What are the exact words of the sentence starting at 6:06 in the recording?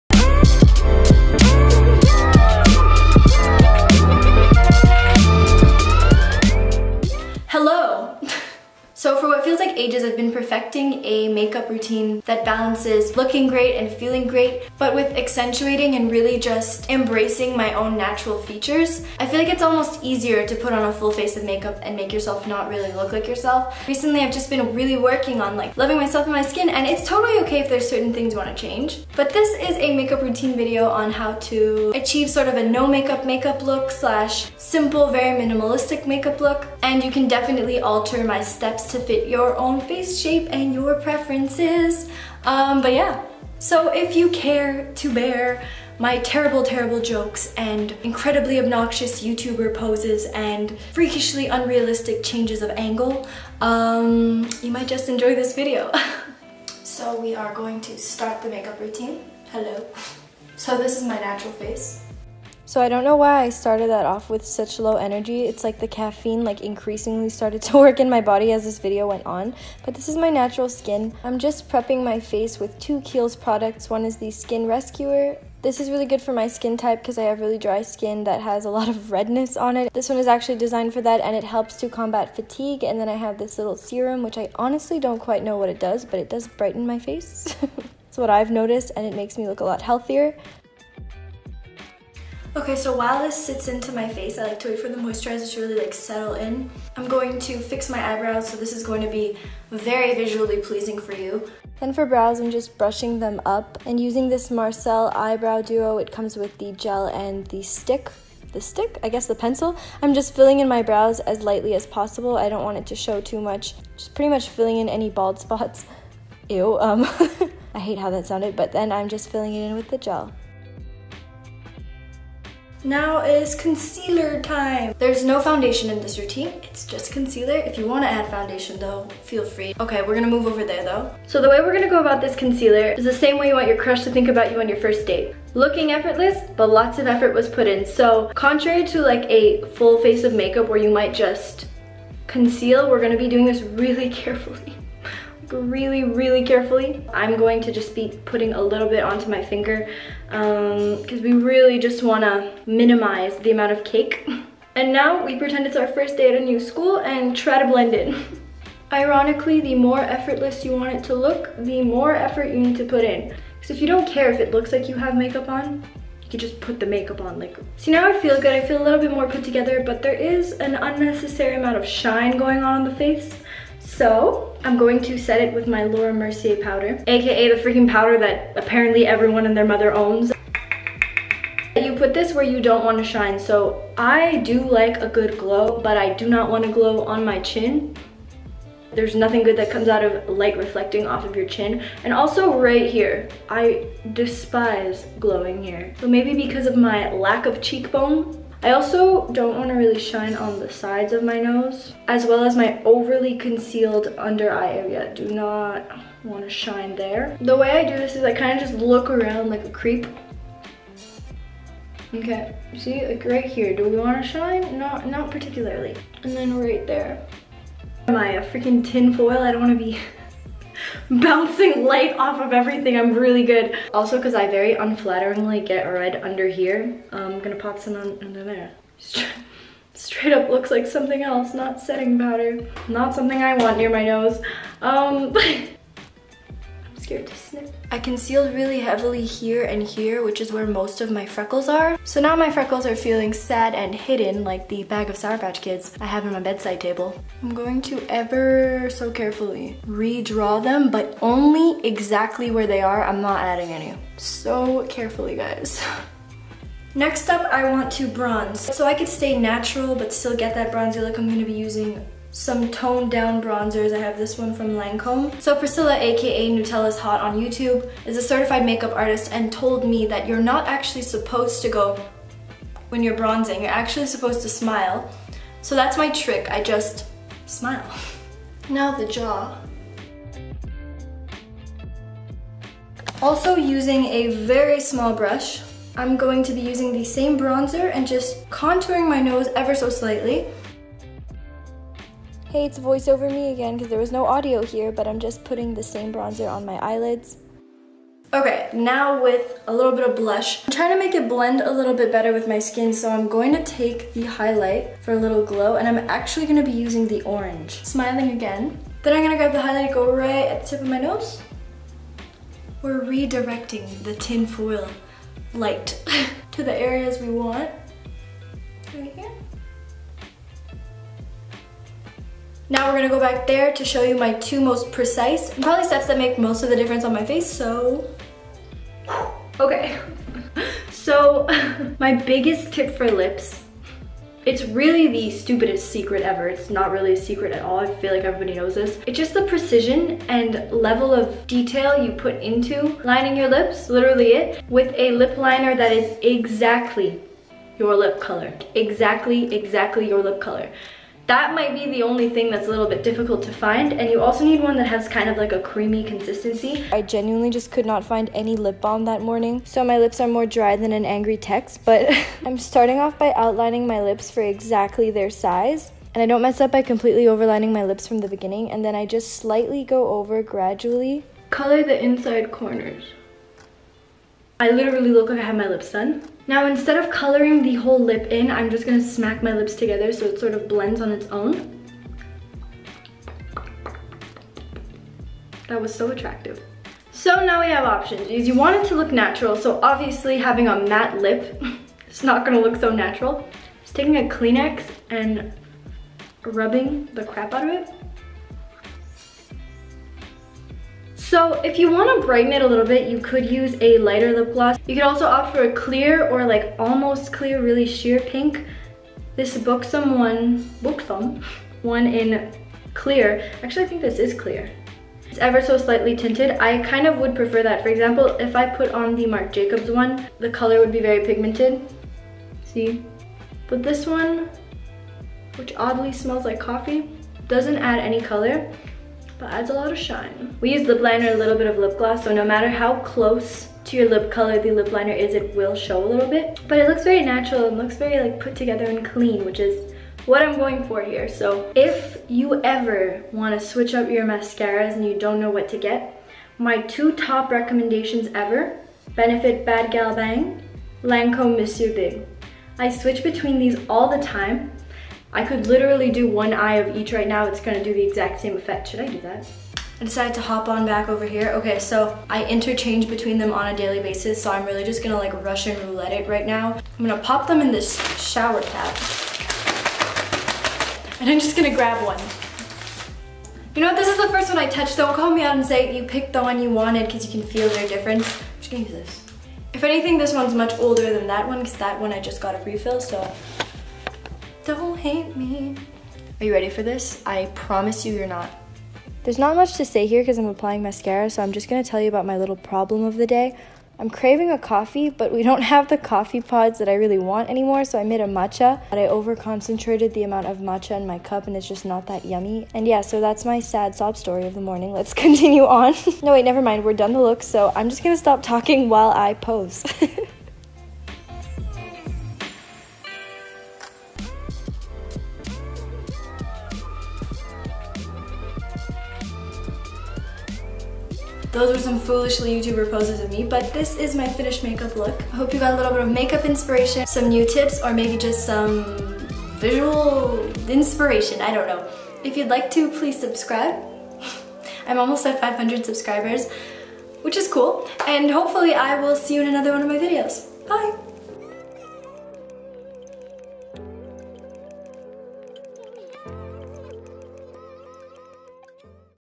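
And I don't mess up by completely overlining my lips from the beginning and then I just slightly go over gradually.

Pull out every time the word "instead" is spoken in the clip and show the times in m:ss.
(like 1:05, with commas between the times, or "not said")
6:16.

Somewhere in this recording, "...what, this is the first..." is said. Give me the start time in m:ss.
7:53.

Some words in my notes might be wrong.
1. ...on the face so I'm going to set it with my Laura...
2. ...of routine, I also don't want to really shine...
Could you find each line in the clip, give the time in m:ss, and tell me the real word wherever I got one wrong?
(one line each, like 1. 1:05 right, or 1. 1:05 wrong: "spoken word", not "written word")
1. 2:52 right
2. 3:17 wrong: "cheekbone", not "routine".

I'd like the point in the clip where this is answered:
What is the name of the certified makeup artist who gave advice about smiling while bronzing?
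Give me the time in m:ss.
4:25.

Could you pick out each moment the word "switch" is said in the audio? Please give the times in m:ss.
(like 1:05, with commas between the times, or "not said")
7:23, 7:32.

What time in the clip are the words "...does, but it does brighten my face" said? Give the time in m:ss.
1:25.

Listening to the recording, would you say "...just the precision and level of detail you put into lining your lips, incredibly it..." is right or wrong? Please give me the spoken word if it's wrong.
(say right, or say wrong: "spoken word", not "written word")
wrong: "literally", not "incredibly".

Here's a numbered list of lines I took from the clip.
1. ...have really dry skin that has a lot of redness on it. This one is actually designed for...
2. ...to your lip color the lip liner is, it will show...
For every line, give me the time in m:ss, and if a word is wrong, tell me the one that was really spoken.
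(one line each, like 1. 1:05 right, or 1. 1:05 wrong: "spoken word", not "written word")
1. 1:17 right
2. 7:13 right.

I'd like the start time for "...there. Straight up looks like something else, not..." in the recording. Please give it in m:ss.
3:48.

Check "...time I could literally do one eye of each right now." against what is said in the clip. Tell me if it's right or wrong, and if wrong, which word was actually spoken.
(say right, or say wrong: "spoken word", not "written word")
right.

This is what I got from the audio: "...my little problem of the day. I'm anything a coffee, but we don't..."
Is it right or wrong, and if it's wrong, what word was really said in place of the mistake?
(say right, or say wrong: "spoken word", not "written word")
wrong: "craving", not "anything".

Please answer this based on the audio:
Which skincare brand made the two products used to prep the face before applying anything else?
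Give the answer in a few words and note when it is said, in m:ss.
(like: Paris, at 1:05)
Kiehl's, at 1:13.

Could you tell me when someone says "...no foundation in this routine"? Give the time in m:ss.
2:05.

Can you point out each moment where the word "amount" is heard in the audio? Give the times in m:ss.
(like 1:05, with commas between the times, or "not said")
2:33, 2:51, 8:20.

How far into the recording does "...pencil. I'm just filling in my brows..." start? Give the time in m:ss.
1:49.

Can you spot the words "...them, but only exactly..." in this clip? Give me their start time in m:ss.
4:10.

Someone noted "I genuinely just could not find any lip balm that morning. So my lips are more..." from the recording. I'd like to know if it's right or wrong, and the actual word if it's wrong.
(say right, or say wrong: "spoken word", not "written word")
right.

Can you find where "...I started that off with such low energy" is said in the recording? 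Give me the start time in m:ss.
1:03.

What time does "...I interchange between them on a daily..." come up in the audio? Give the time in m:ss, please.
7:42.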